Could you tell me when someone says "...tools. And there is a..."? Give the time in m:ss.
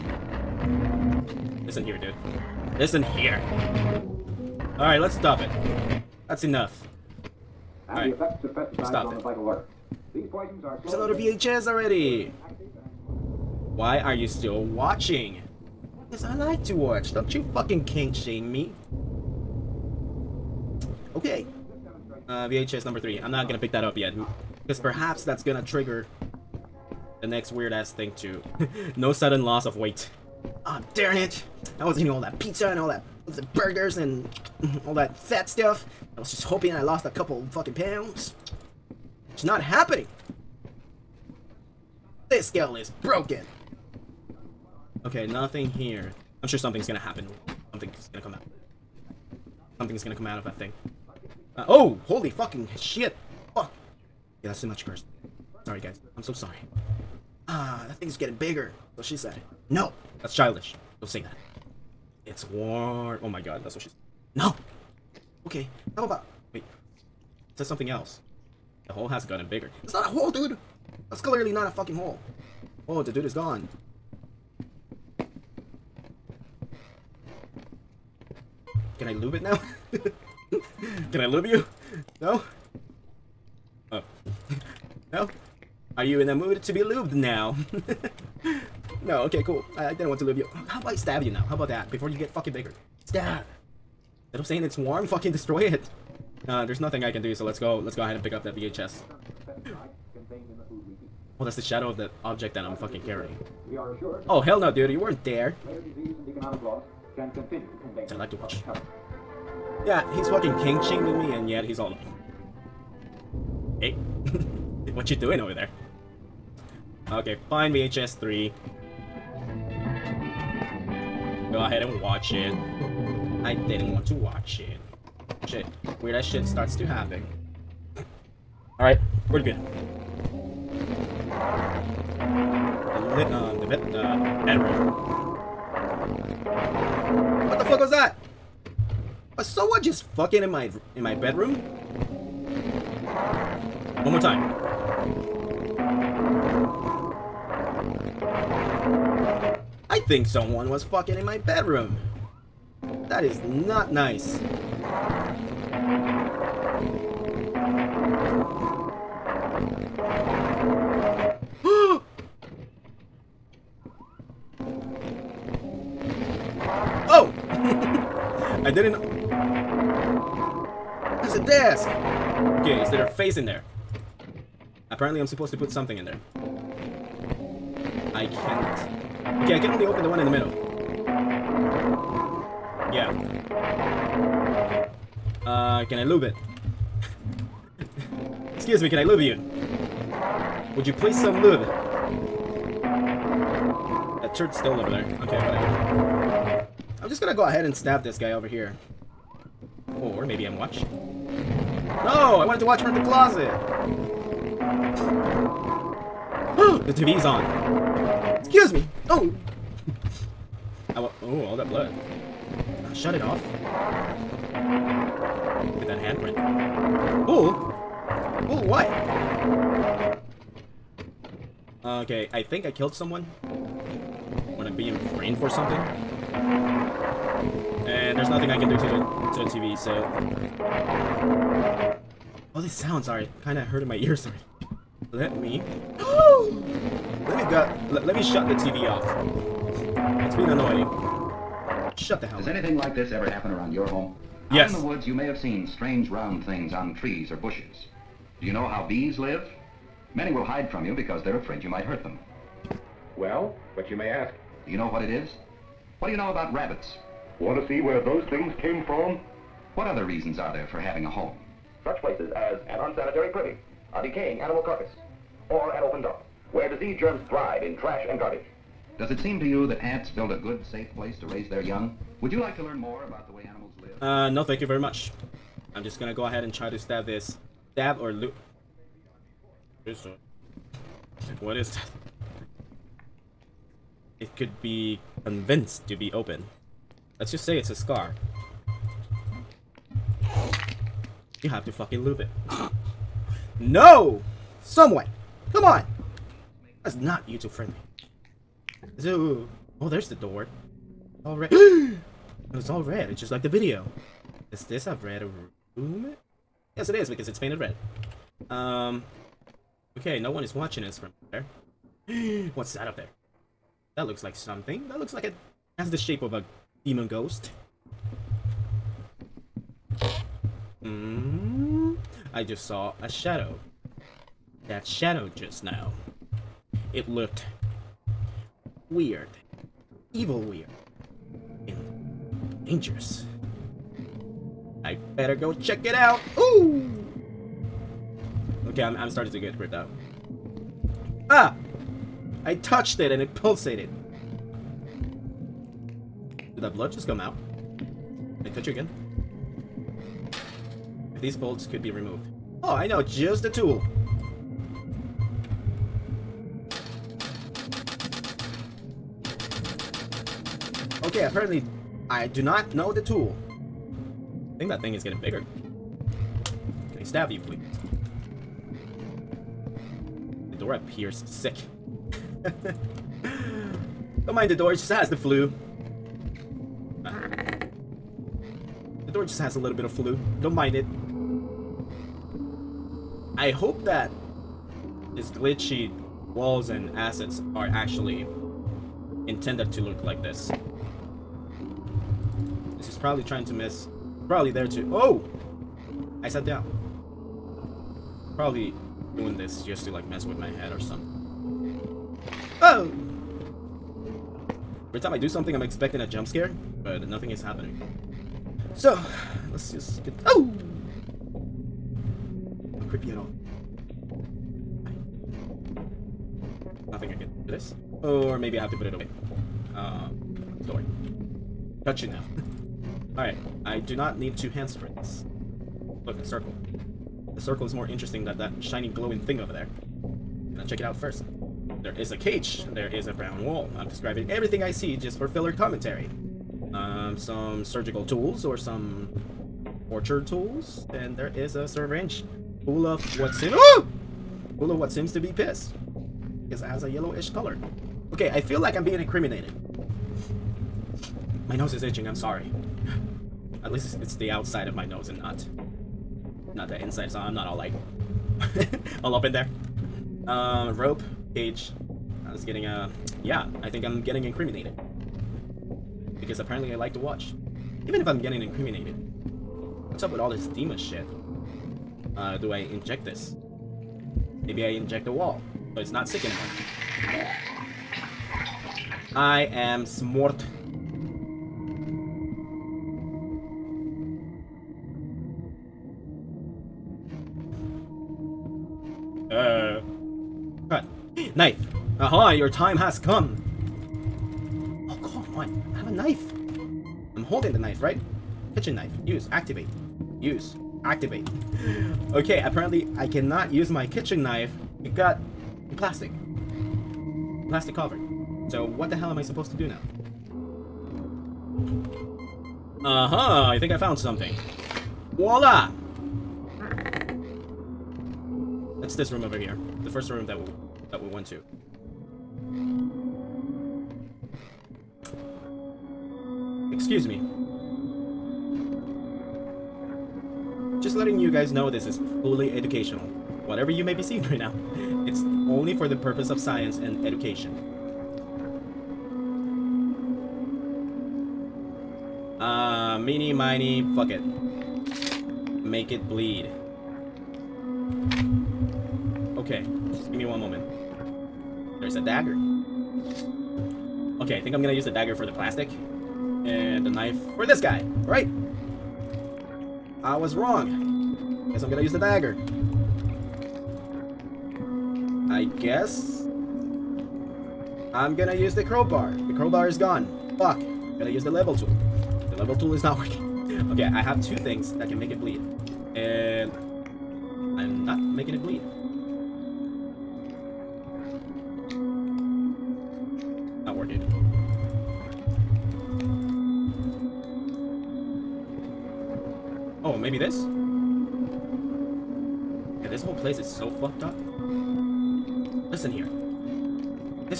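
7:20.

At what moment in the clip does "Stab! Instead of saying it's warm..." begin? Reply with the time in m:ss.
1:33.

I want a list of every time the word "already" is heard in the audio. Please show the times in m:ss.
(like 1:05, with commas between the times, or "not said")
0:11, 3:54.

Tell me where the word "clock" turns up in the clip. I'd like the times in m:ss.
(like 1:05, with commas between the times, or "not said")
not said.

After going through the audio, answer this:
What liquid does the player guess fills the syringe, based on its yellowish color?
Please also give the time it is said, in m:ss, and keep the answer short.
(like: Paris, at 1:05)
Piss, at 7:25.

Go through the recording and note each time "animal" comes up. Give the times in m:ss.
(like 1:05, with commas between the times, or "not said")
4:24, 4:33.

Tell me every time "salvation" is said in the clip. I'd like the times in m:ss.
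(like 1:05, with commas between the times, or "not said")
not said.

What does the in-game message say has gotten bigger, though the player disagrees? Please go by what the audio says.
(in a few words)
The hole.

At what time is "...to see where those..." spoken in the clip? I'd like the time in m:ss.
4:17.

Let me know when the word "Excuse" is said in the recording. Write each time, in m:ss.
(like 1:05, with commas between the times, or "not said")
3:08, 3:28, 8:46.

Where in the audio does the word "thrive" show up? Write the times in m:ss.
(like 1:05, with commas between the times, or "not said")
4:27.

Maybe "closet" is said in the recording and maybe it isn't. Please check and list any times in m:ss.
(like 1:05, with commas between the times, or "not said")
3:23.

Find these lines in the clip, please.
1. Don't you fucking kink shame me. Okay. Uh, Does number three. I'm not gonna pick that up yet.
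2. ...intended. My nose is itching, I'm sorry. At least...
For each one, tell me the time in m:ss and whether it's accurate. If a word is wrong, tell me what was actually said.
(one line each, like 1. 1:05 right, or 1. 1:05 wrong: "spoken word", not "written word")
1. 0:17 wrong: "VHS", not "Does"
2. 7:28 wrong: "incriminated", not "intended".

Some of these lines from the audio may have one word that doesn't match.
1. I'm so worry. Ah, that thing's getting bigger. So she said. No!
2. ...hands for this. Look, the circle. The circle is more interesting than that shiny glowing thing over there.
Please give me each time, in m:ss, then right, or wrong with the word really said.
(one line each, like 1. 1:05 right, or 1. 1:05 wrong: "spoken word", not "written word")
1. 0:56 wrong: "sorry", not "worry"
2. 7:04 right.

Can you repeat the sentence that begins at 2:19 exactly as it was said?
Was someone just fucking in my in my bedroom?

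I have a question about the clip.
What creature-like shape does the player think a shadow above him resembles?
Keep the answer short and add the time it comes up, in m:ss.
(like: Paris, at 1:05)
A demon ghost, at 5:16.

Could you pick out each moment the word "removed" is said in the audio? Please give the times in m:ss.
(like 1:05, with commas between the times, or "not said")
5:51.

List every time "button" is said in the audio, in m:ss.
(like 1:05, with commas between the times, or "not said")
not said.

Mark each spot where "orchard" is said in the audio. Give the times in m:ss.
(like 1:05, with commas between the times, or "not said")
7:19.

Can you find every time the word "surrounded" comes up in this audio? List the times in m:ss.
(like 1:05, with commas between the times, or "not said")
not said.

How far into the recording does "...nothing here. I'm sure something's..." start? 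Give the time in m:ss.
0:45.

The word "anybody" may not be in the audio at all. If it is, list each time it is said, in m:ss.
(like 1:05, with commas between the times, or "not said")
not said.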